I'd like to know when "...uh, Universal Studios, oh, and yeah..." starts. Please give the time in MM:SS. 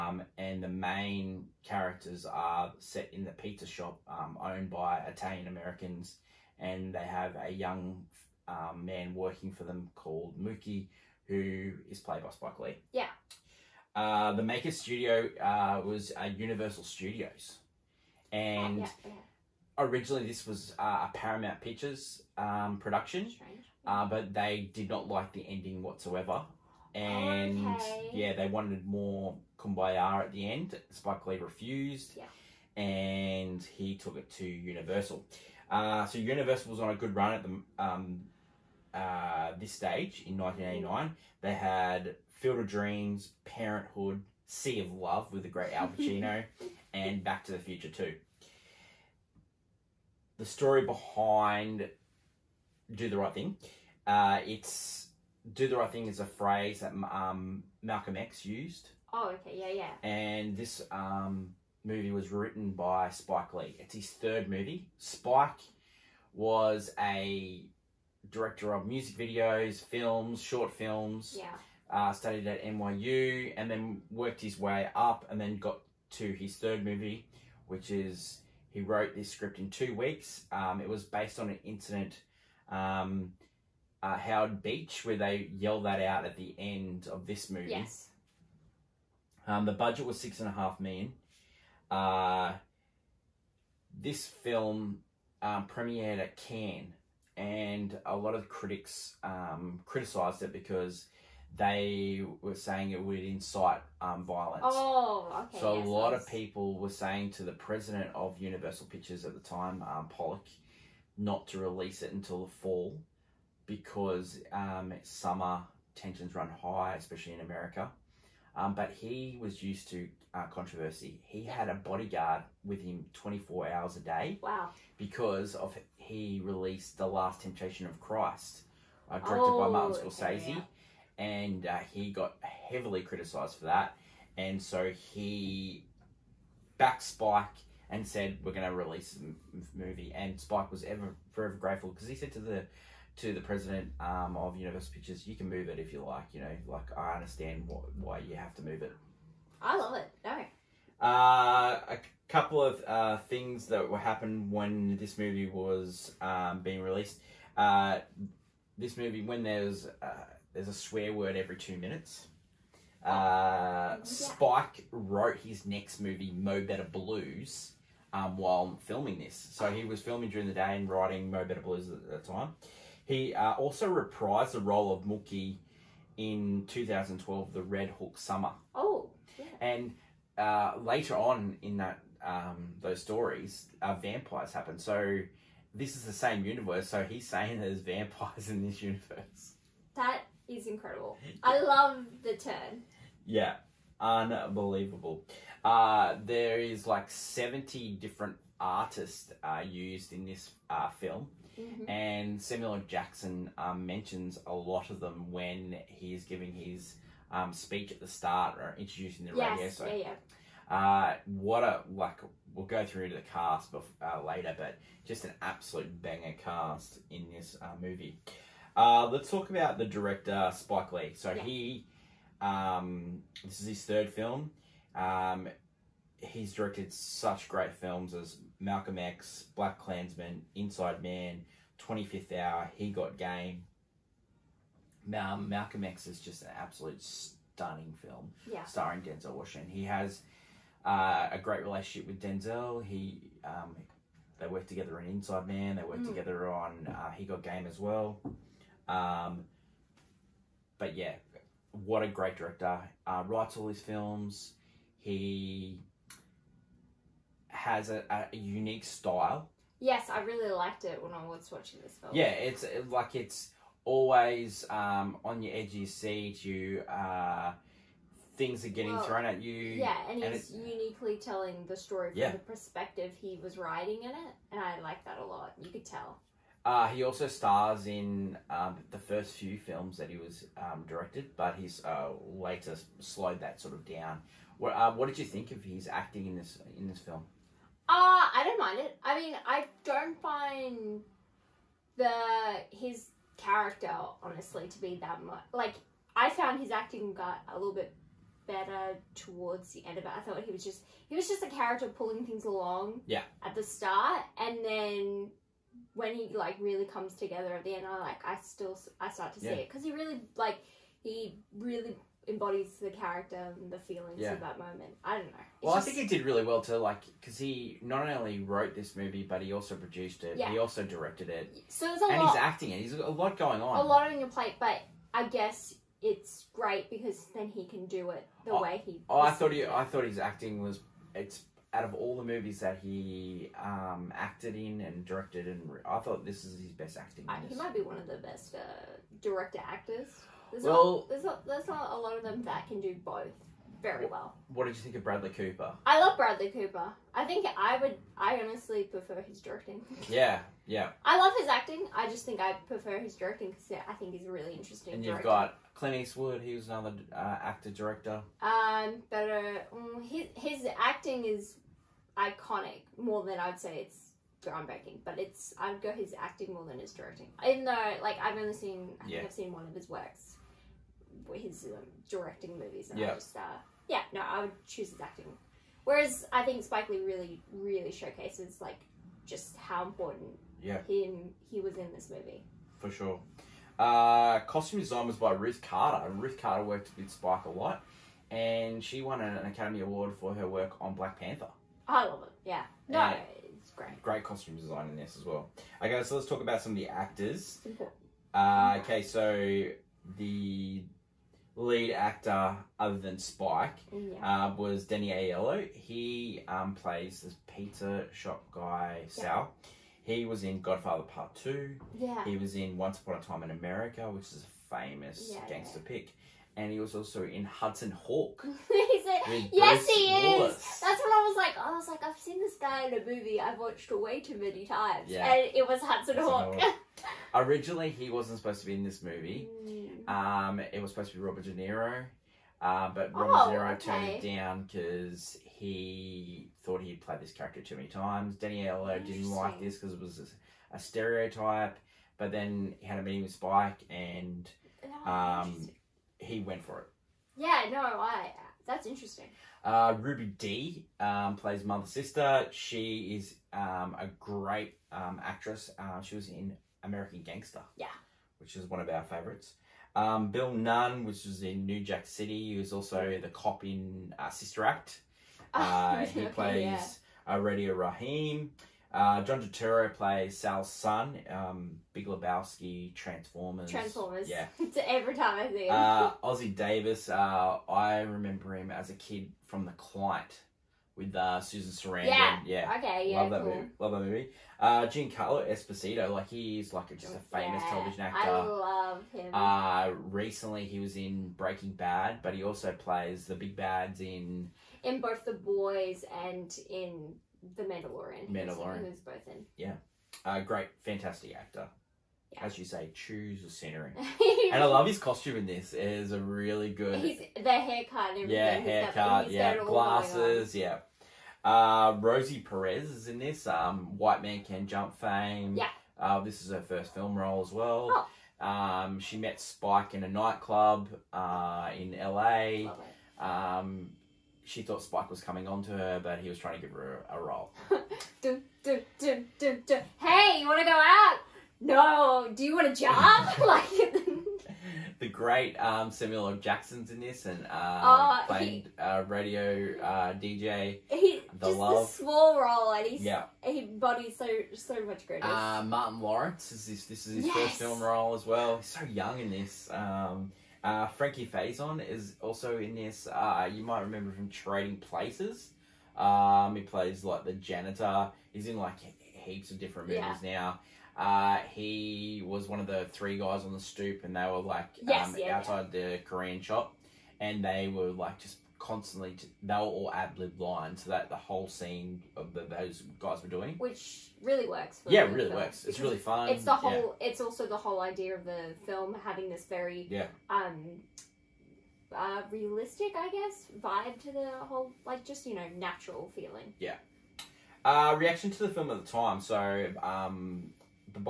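00:16.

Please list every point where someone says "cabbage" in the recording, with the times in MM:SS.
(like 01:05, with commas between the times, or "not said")
not said.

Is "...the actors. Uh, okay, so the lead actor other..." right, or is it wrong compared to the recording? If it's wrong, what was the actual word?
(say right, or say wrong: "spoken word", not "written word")
right.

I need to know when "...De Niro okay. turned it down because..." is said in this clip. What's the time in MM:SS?
07:13.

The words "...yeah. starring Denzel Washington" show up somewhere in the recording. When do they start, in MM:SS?
03:58.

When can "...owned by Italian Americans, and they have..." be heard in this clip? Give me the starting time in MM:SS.
00:04.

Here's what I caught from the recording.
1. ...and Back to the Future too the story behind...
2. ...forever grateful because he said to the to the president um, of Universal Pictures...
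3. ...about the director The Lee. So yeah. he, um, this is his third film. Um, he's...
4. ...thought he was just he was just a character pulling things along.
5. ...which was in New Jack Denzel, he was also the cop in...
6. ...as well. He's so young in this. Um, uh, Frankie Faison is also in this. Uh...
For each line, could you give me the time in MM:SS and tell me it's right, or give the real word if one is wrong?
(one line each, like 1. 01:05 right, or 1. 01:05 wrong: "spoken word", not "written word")
1. 00:46 right
2. 02:21 right
3. 03:39 wrong: "Spike", not "The"
4. 05:00 right
5. 07:41 wrong: "City", not "Denzel"
6. 09:08 right.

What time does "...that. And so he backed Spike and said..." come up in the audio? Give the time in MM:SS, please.
02:13.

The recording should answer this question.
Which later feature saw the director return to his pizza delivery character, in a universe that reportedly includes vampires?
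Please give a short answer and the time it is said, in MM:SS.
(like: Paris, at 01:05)
Red Hook Summer, at 02:57.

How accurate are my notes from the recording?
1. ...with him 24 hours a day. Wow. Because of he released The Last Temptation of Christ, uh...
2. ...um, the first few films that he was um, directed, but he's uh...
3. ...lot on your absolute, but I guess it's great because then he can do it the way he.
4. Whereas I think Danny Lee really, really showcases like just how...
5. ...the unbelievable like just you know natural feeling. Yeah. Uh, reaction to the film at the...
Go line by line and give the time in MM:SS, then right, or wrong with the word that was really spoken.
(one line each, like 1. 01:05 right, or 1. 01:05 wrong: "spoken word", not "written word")
1. 02:02 right
2. 04:38 right
3. 05:23 wrong: "plate", not "absolute"
4. 06:15 wrong: "Spike", not "Danny"
5. 09:44 wrong: "whole", not "unbelievable".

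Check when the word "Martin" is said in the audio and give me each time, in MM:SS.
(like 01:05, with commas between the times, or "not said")
02:09, 09:05.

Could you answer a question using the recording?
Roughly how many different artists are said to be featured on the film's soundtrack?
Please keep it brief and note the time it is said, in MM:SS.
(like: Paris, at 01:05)
70, at 03:17.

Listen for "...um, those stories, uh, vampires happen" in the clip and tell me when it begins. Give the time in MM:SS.
03:02.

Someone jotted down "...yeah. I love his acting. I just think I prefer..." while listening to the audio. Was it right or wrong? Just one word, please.
right.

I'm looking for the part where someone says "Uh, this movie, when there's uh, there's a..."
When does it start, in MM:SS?
02:37.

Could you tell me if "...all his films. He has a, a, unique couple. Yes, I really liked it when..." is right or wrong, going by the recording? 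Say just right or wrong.
wrong.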